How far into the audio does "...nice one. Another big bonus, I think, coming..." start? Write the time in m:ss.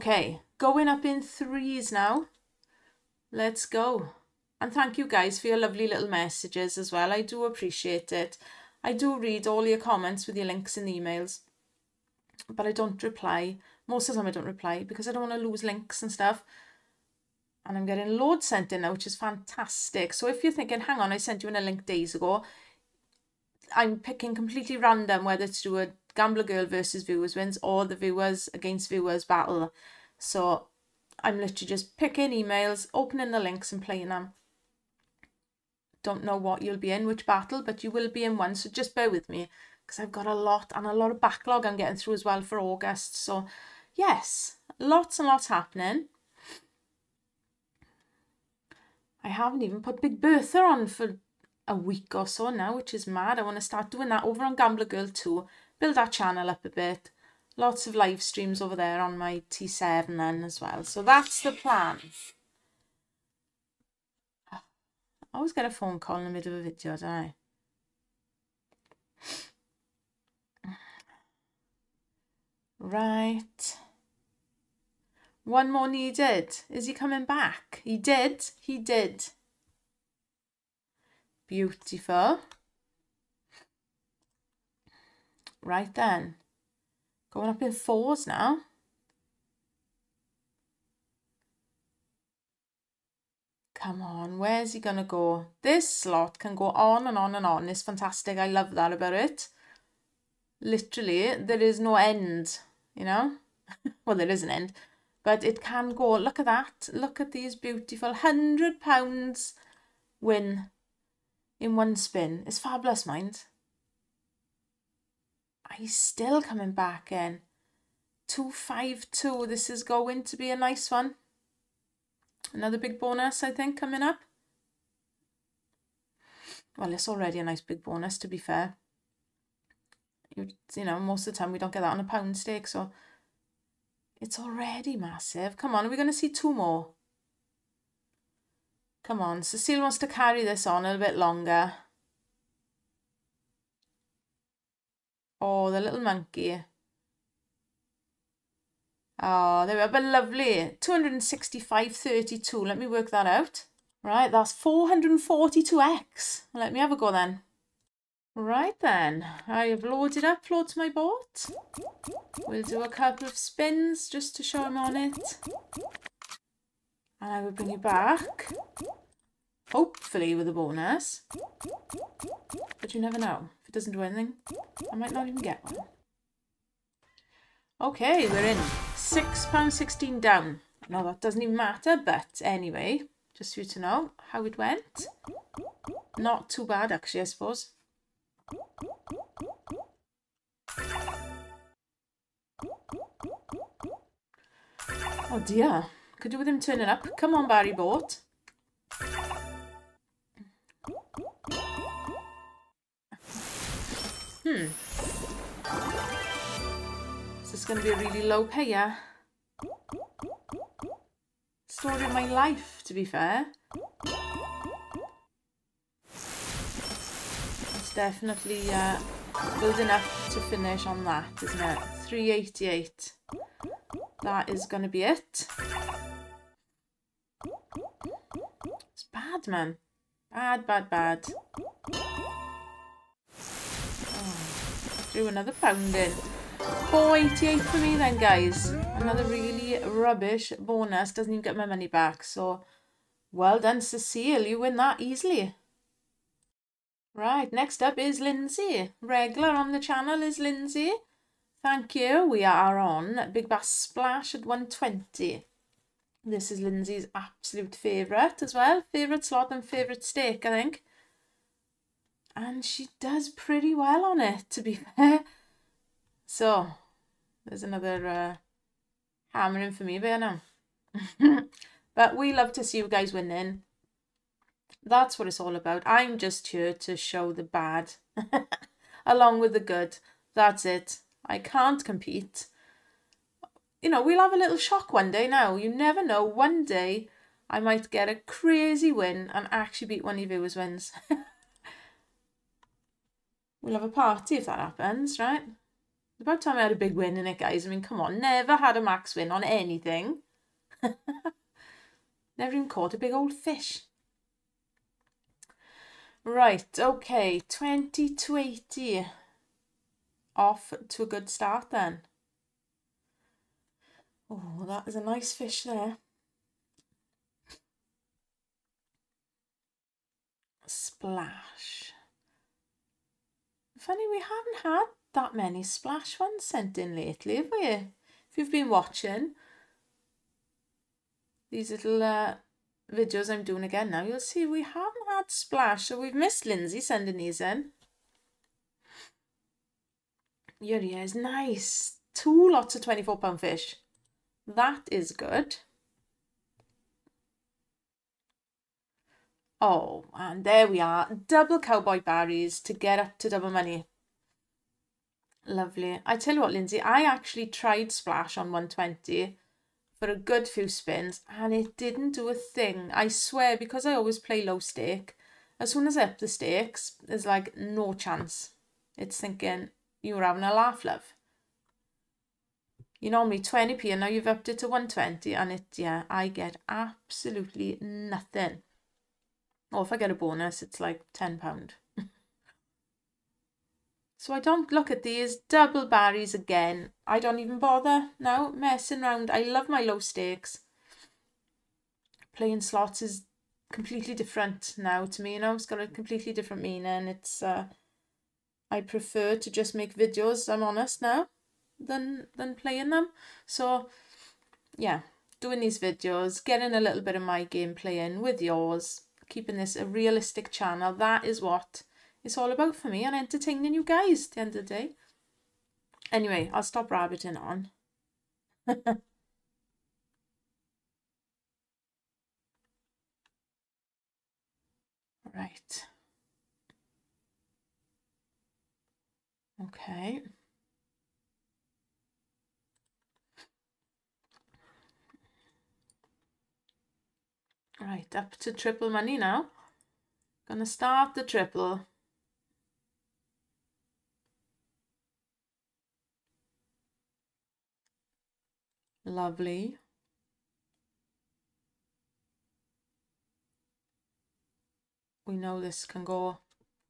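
2:00.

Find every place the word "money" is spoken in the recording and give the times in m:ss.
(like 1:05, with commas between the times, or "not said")
4:01, 5:53, 7:18.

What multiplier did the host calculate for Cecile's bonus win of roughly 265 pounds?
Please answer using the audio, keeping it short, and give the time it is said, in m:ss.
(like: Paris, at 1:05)
442x, at 2:34.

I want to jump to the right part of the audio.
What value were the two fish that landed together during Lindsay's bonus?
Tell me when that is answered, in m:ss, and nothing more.
5:42.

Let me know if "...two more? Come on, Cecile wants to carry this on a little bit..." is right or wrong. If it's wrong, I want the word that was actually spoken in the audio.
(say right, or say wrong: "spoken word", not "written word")
right.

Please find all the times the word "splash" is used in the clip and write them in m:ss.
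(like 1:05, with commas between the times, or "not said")
4:13, 5:20, 5:25, 5:35, 5:57.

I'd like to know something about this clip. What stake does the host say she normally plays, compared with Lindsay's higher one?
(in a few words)
20p.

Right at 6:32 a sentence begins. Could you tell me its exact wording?
Playing slots is completely different now to me.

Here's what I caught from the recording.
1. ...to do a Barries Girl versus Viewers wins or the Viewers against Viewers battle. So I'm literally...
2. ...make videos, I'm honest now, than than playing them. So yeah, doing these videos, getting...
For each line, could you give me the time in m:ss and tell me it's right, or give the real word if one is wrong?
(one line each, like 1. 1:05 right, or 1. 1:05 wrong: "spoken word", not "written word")
1. 0:25 wrong: "Gambler", not "Barries"
2. 6:39 right.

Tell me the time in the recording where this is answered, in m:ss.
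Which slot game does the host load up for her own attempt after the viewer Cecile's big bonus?
2:40.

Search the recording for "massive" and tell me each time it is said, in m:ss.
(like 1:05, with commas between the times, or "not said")
2:14.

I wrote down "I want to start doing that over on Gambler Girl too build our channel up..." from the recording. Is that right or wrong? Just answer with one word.
right.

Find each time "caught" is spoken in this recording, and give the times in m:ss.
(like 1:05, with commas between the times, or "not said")
5:02.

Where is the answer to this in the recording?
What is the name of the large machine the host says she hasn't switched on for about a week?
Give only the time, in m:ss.
0:50.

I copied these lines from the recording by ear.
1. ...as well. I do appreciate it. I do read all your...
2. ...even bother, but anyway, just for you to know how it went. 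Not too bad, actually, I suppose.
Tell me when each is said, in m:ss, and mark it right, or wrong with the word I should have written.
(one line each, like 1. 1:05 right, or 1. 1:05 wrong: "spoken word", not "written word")
1. 0:06 right
2. 3:01 wrong: "matter", not "bother".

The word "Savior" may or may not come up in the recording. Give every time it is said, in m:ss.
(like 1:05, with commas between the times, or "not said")
not said.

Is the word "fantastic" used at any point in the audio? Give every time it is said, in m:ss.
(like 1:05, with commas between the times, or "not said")
0:19, 1:37.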